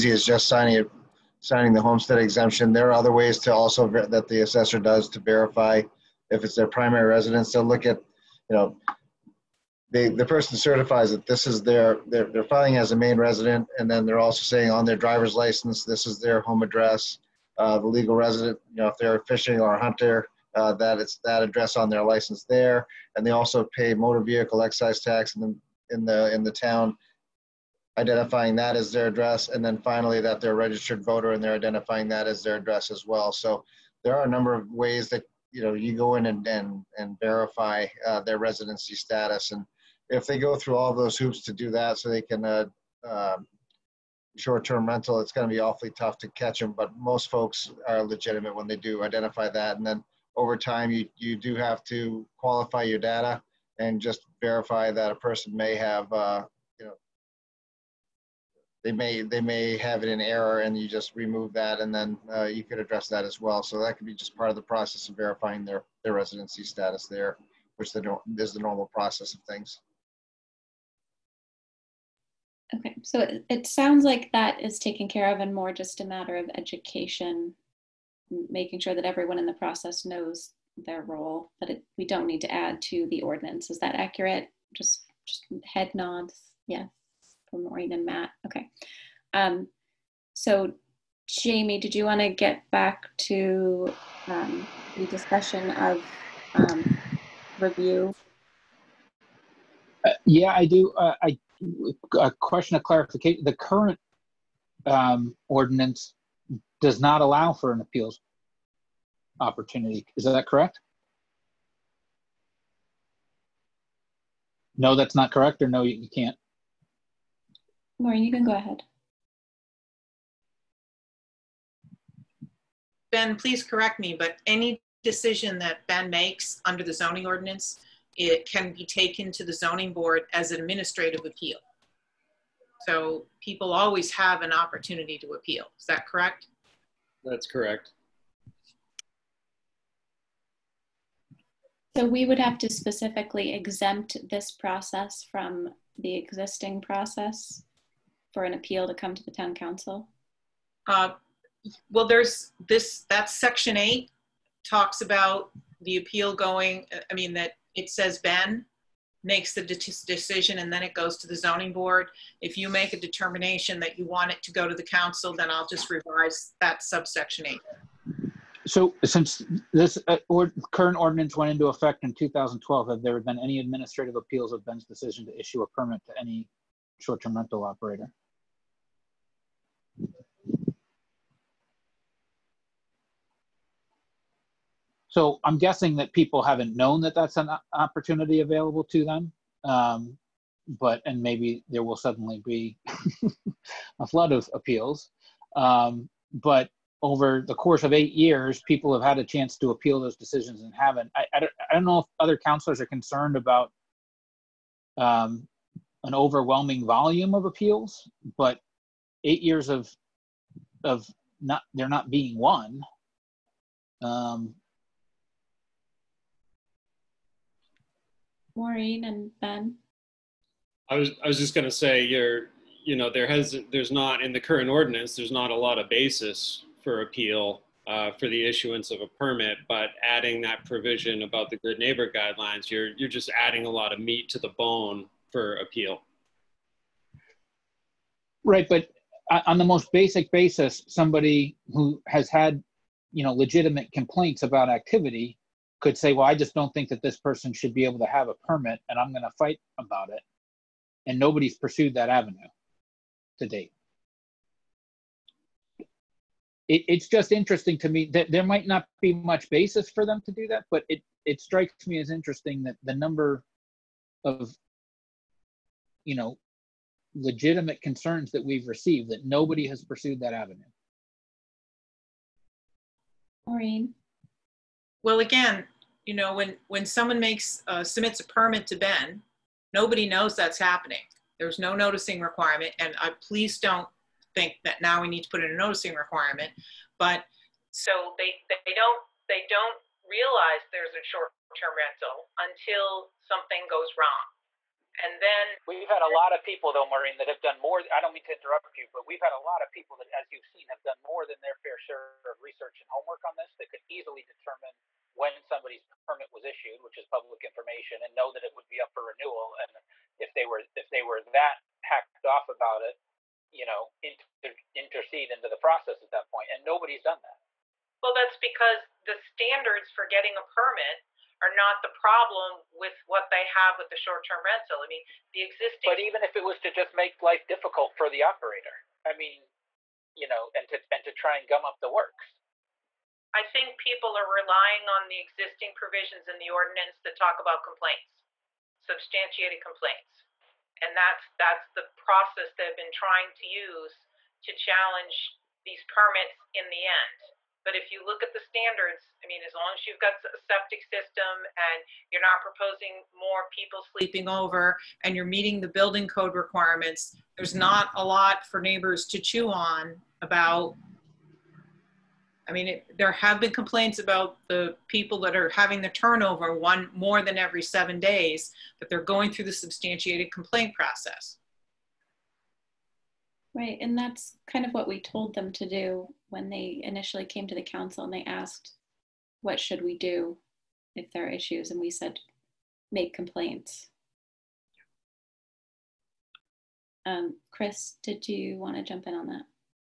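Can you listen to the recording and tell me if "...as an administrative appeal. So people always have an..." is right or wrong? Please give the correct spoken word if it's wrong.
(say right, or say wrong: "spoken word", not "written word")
right.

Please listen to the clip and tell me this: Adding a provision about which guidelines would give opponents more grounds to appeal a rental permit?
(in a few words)
Good neighbor guidelines.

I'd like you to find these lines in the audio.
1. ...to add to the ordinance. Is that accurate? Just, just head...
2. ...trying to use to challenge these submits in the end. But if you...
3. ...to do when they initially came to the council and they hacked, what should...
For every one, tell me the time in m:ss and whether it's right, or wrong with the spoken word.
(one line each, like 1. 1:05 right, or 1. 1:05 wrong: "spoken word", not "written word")
1. 1:22 right
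2. 5:42 wrong: "permits", not "submits"
3. 6:15 wrong: "asked", not "hacked".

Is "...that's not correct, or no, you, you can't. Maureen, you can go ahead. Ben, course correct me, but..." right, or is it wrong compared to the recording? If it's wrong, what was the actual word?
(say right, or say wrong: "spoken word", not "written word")
wrong: "please", not "course".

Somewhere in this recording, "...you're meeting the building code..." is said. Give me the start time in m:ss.
5:55.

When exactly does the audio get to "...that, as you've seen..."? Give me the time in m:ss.
4:59.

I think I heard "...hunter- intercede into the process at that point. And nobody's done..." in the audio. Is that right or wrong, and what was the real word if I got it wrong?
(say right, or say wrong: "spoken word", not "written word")
wrong: "inter", not "hunter".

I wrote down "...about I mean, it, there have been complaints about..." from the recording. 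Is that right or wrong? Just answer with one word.
right.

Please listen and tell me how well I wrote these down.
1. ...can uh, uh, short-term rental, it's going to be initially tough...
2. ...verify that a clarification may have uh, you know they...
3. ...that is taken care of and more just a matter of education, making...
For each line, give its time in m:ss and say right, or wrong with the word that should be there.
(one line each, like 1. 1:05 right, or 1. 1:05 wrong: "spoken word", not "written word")
1. 0:42 wrong: "awfully", not "initially"
2. 0:54 wrong: "person", not "clarification"
3. 1:14 right.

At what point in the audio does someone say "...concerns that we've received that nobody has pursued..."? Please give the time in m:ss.
4:27.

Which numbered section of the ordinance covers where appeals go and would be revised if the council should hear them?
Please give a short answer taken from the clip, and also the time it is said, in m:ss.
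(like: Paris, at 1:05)
Section 8, at 2:33.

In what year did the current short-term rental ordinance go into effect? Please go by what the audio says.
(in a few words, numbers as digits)
2012.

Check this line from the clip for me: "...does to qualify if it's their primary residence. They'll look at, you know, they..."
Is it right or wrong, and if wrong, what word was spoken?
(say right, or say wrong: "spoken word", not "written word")
wrong: "verify", not "qualify".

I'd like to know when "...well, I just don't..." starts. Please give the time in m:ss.
4:06.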